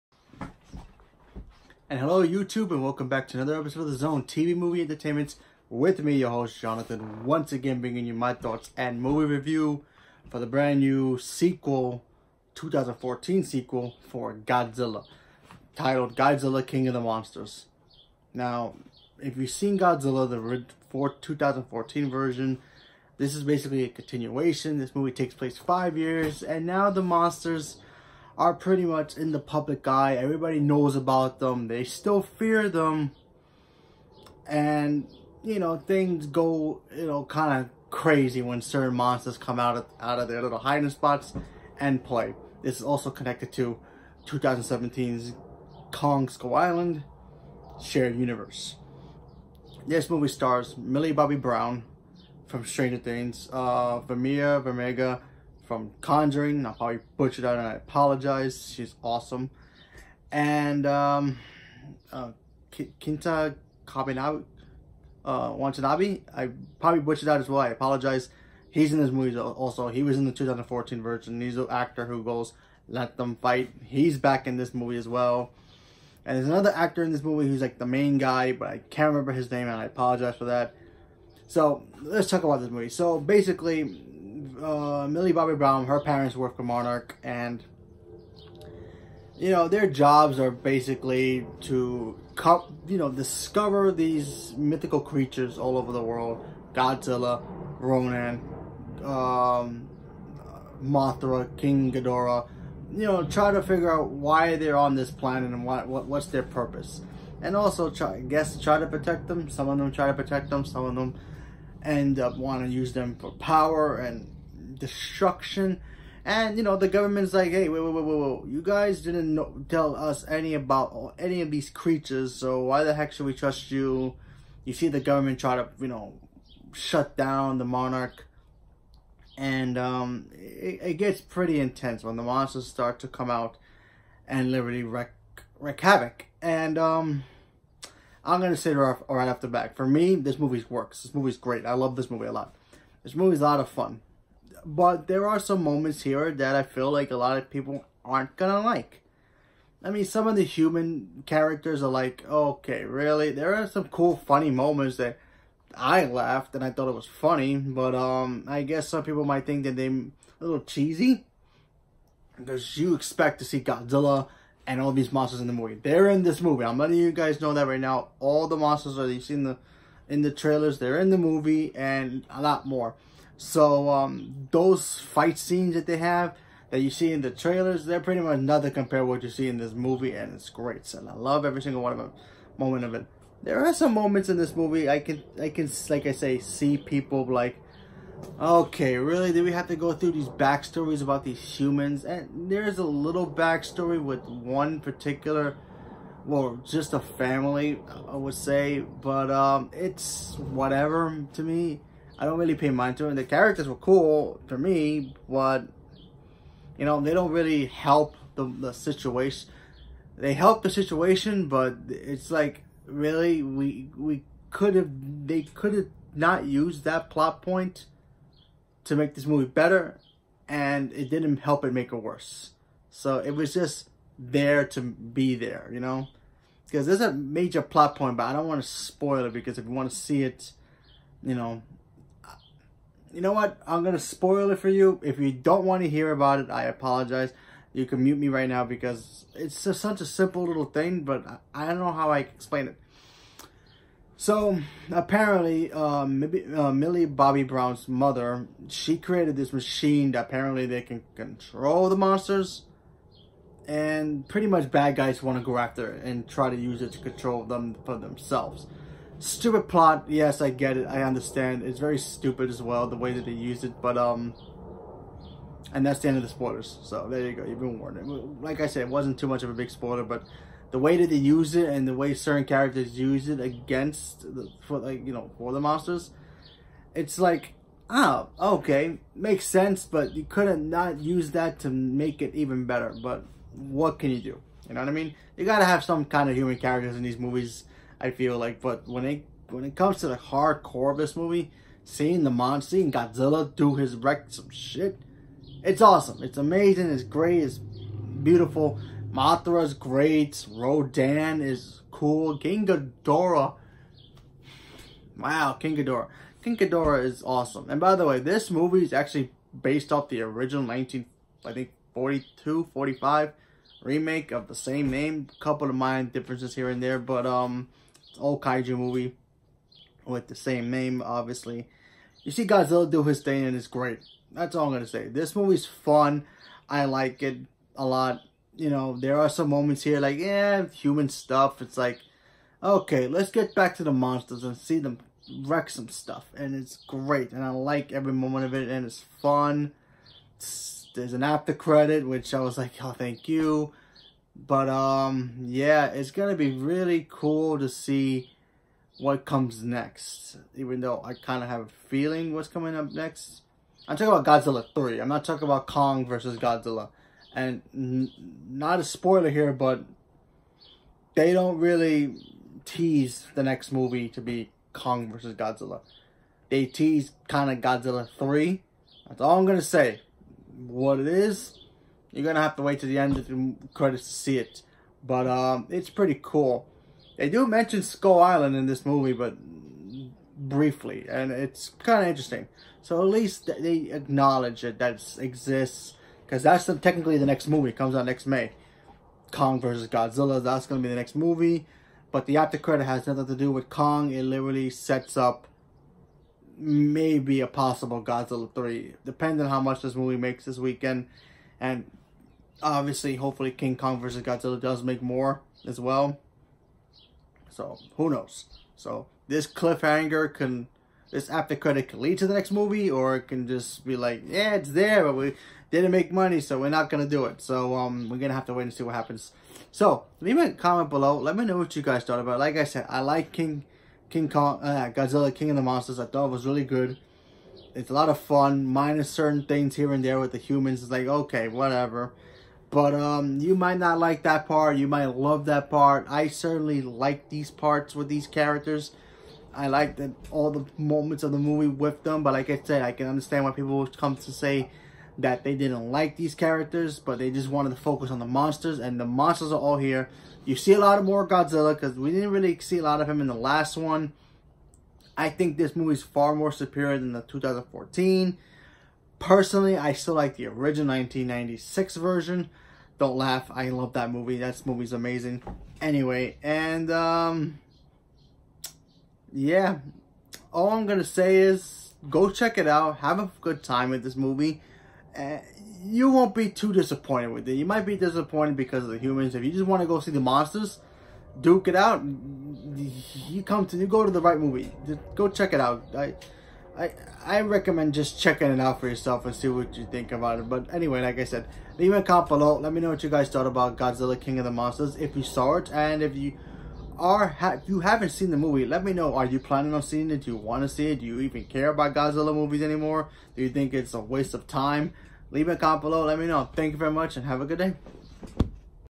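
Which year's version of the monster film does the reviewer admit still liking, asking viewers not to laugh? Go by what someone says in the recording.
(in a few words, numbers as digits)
1996.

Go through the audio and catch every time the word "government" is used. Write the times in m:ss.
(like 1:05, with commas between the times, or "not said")
1:56, 2:04.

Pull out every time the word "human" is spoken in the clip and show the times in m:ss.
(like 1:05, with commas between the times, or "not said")
2:30, 3:11, 4:46, 5:30, 7:10, 7:58.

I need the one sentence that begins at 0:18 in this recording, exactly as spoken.
Now, if you've seen Godzilla, the 2014 version, this is basically a continuation.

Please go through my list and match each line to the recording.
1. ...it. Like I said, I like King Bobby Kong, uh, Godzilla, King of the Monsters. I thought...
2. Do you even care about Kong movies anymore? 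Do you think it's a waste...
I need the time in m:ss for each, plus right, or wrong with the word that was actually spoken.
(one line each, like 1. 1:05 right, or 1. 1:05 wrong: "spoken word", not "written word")
1. 7:02 wrong: "King", not "Bobby"
2. 8:21 wrong: "Godzilla", not "Kong".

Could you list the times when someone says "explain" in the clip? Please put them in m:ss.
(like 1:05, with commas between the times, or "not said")
4:02.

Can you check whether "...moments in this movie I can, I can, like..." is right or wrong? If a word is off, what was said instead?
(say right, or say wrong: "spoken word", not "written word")
right.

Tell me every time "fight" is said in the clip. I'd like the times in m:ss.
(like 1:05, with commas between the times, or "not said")
1:13, 2:54.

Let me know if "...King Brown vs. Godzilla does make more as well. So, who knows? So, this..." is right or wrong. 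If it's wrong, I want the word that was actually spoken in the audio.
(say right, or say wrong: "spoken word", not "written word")
wrong: "Kong", not "Brown".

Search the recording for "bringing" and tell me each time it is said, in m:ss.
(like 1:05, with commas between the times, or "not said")
0:07.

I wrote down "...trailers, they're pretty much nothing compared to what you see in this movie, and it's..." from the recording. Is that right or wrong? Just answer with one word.
right.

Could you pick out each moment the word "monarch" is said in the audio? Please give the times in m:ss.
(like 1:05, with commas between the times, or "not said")
1:26, 2:07.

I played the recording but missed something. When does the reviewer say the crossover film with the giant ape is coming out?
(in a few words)
Next May.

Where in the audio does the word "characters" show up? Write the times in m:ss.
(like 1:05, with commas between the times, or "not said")
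2:31, 3:23, 4:32, 4:46, 7:18, 7:26.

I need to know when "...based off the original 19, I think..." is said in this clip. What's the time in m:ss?
5:09.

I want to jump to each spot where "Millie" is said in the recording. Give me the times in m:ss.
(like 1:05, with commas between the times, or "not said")
0:50, 1:25, 4:06.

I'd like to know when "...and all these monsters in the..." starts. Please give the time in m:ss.
2:44.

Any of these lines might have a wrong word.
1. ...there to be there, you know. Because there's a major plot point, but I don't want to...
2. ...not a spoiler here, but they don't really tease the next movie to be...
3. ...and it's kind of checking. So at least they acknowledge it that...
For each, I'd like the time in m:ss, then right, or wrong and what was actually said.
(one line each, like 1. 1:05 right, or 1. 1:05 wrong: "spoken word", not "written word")
1. 3:44 right
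2. 5:58 right
3. 6:21 wrong: "interesting", not "checking".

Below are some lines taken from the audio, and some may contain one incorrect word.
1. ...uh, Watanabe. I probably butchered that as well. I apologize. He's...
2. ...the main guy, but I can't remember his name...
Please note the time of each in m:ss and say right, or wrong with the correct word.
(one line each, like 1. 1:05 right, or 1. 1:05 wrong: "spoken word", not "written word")
1. 1:05 right
2. 1:17 right.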